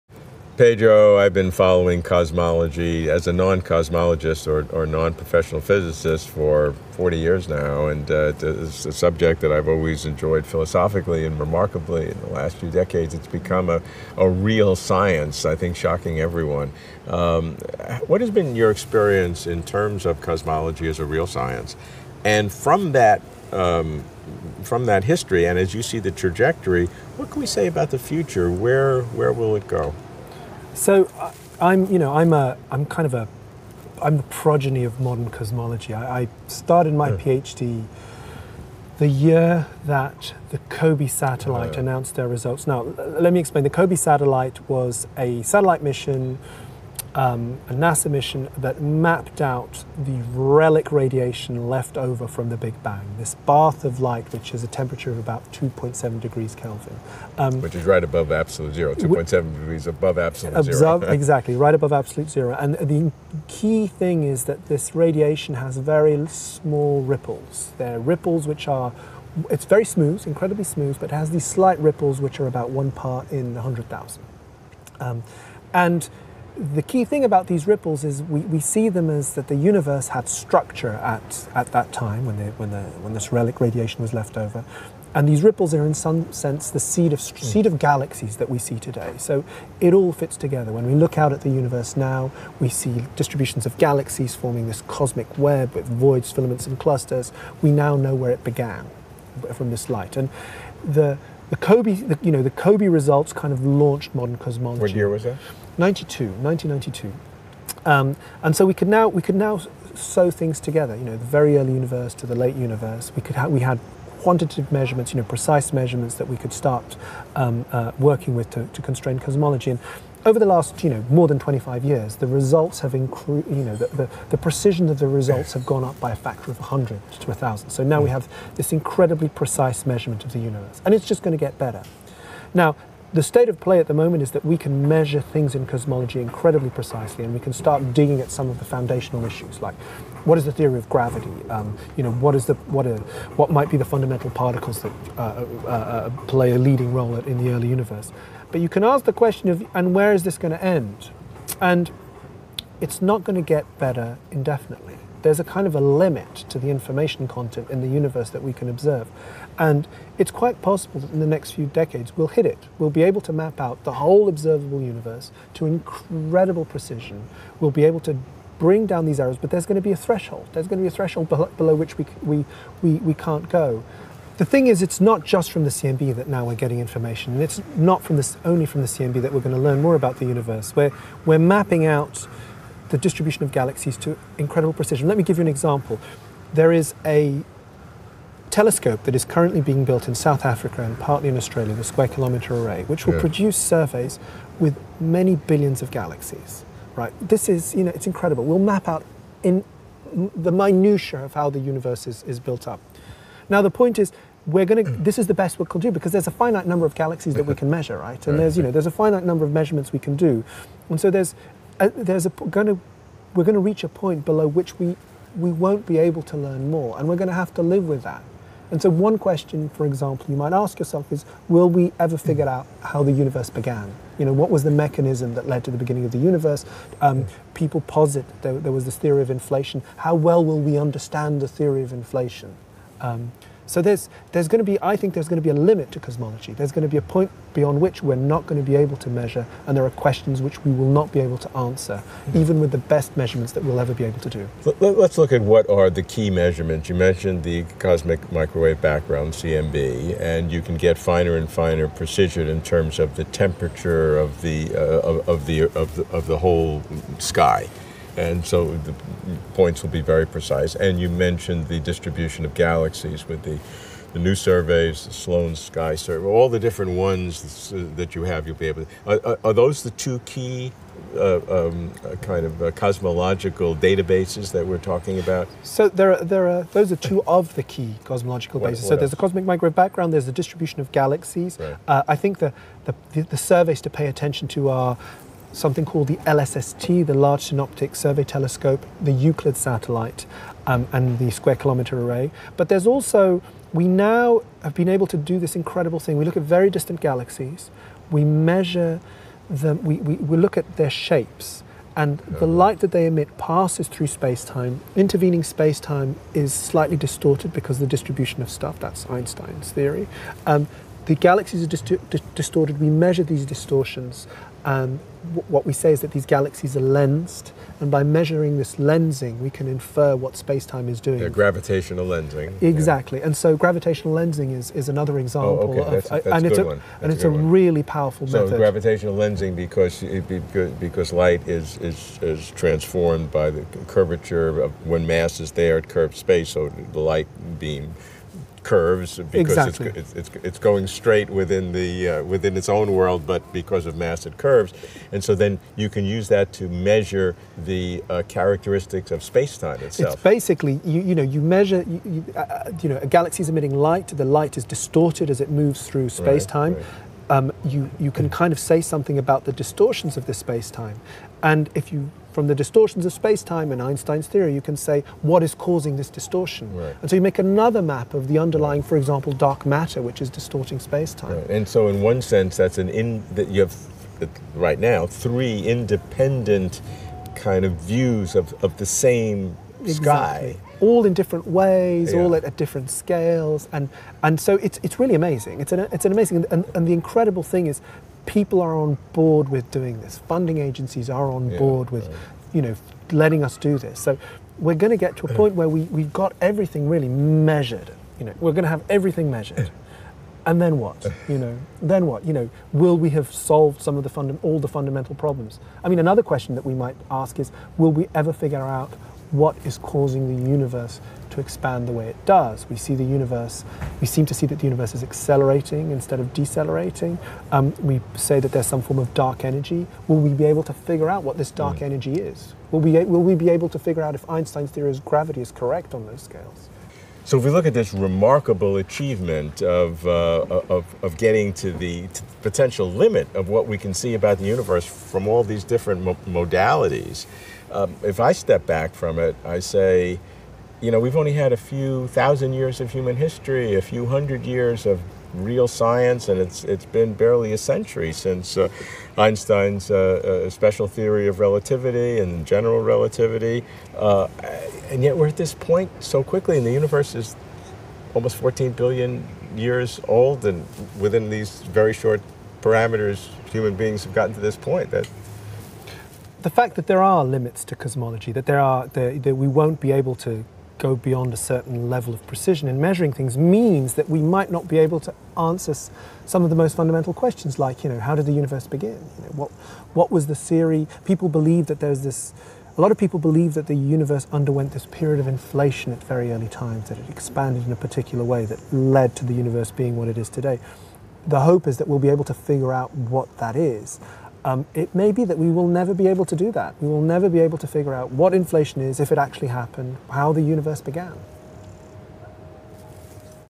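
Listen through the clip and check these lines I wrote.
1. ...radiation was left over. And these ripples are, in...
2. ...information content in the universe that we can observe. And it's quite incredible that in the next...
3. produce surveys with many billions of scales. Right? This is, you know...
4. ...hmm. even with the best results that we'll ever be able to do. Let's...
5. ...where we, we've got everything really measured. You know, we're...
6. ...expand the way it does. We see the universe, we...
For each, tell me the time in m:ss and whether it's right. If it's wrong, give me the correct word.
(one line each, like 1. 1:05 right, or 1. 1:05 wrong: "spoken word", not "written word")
1. 1:23 right
2. 2:36 wrong: "possible", not "incredible"
3. 3:13 wrong: "galaxies", not "scales"
4. 4:01 wrong: "measurements", not "results"
5. 6:35 right
6. 6:51 right.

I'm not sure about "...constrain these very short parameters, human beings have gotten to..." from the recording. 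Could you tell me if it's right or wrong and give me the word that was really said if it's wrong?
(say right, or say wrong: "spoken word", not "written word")
wrong: "within", not "constrain".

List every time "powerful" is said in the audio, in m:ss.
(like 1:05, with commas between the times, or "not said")
5:27.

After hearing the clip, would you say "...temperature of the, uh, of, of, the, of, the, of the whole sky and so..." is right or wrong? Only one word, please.
right.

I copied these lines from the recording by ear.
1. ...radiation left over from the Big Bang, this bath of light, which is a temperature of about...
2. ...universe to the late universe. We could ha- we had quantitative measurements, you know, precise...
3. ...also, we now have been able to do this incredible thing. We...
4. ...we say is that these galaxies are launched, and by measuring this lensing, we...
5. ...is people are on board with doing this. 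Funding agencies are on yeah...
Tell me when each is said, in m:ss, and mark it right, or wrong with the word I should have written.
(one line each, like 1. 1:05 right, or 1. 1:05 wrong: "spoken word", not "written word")
1. 0:50 right
2. 1:51 right
3. 4:52 right
4. 5:15 wrong: "lensed", not "launched"
5. 6:27 right.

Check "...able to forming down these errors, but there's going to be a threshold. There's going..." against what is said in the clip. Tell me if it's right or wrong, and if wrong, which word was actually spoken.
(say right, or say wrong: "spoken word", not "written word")
wrong: "bring", not "forming".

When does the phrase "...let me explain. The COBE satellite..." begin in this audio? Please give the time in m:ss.
0:42.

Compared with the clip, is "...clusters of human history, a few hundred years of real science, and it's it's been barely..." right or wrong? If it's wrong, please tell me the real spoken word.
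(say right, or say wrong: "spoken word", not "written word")
wrong: "years", not "clusters".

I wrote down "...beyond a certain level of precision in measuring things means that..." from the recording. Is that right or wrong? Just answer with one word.
right.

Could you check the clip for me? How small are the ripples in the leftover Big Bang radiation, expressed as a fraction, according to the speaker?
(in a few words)
one part in 100,000.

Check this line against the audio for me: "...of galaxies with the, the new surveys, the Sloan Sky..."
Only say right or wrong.
right.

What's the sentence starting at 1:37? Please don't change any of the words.
We now know where it began from this light.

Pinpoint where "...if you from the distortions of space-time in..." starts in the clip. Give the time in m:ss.
6:01.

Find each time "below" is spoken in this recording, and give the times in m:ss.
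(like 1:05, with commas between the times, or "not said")
2:51, 3:34.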